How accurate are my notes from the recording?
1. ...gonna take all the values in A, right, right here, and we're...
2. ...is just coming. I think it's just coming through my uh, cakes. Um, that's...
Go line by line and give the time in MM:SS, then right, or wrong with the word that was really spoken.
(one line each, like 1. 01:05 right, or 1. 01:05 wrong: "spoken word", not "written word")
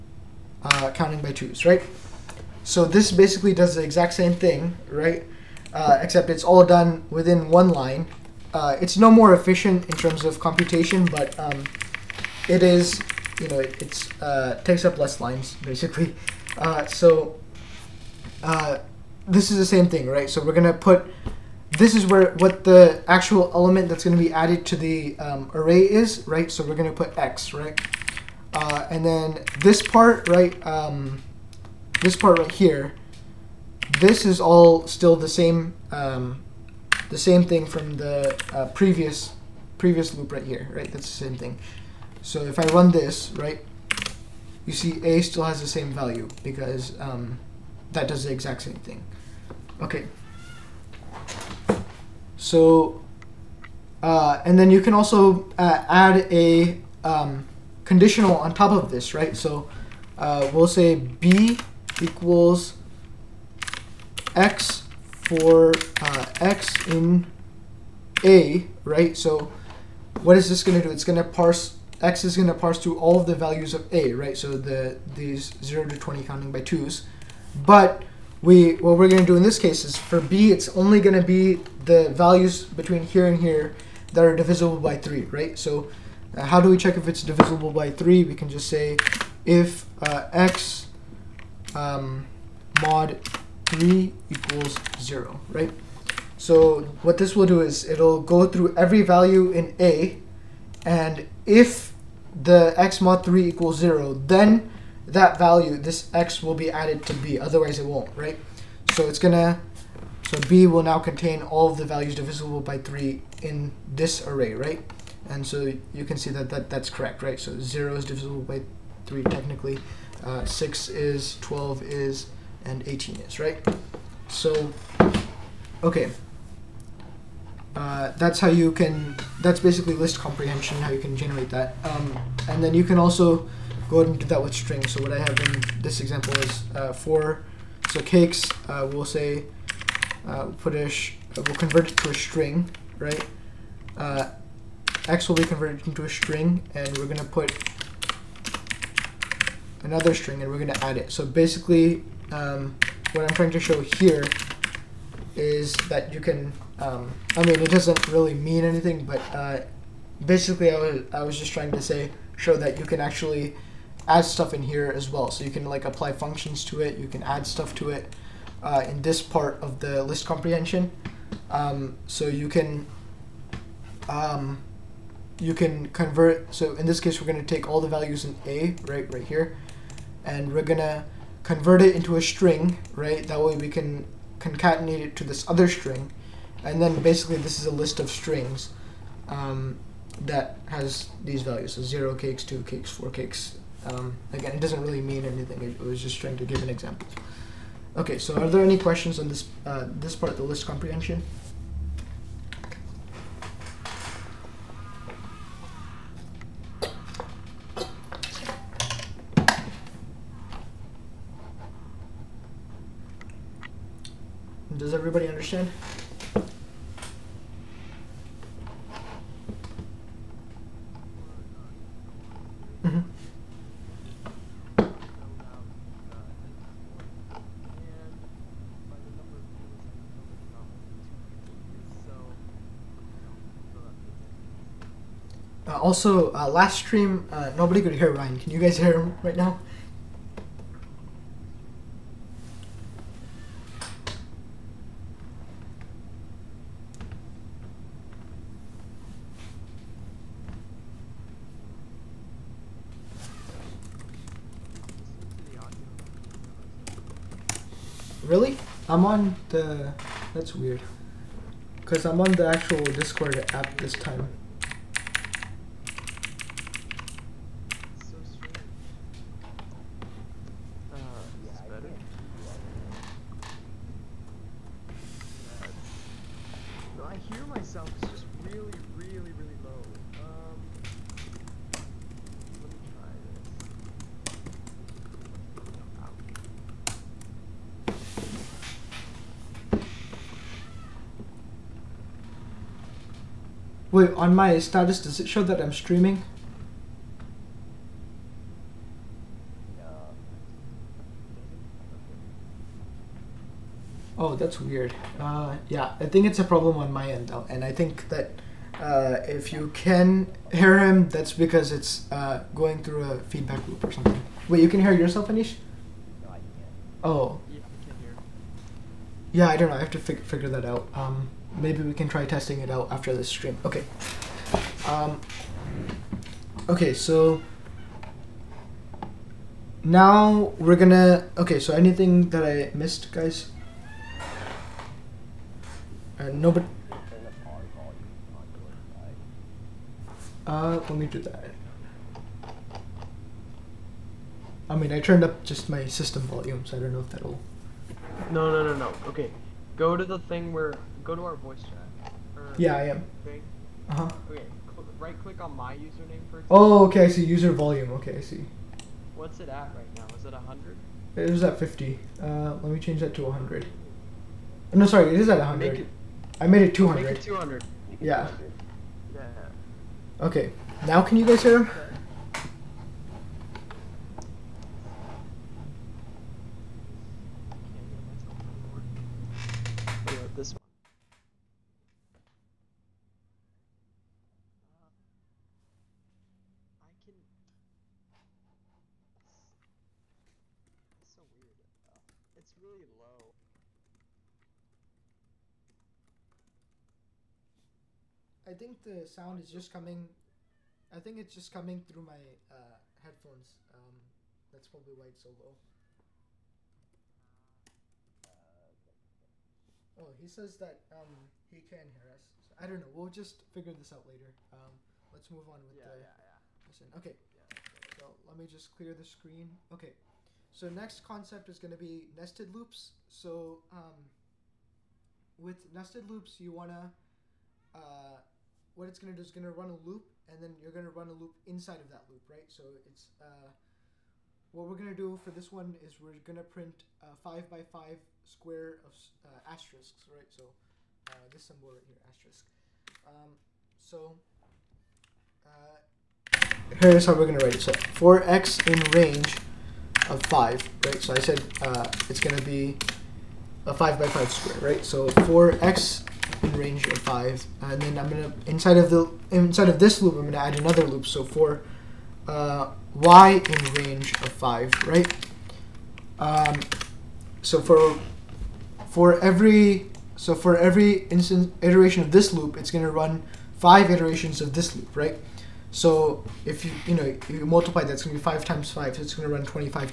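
1. 02:57 right
2. 06:39 wrong: "headphones", not "cakes".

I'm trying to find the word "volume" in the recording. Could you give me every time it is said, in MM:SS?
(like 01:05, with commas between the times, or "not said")
05:46, 05:57.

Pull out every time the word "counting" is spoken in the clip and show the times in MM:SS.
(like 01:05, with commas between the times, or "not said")
00:00, 01:16.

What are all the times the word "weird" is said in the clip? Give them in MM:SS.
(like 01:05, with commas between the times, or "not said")
04:20, 05:04, 06:31.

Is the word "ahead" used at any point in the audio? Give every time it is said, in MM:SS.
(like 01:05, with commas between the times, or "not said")
02:13.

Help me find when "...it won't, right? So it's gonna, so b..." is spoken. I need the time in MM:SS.
01:47.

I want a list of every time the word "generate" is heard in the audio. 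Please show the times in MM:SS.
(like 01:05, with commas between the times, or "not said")
02:11.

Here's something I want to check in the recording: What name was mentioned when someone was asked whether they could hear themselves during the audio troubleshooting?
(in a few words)
Anish.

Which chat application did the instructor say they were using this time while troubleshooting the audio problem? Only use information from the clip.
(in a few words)
Discord.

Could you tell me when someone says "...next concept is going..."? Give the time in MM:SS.
07:00.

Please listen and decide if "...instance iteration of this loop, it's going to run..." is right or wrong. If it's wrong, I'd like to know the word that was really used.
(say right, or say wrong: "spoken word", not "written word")
right.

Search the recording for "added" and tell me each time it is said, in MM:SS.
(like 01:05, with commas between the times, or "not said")
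00:24, 01:46.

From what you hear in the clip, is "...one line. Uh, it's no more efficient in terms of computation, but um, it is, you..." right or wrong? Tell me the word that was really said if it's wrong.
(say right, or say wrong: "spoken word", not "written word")
right.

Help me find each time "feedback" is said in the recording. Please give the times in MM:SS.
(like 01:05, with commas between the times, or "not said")
05:13.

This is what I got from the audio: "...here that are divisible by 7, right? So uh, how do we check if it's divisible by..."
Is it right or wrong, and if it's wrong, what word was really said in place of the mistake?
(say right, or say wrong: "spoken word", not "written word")
wrong: "3", not "7".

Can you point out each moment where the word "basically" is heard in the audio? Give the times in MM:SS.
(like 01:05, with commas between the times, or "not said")
00:03, 00:15, 02:09, 02:31, 02:40, 03:07.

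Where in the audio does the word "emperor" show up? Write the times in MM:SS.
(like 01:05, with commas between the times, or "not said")
not said.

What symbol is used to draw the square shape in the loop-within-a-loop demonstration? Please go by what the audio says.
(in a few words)
asterisk.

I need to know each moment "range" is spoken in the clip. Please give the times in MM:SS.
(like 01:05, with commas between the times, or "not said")
07:28, 07:36, 07:43.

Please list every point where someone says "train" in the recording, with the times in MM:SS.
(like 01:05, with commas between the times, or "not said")
not said.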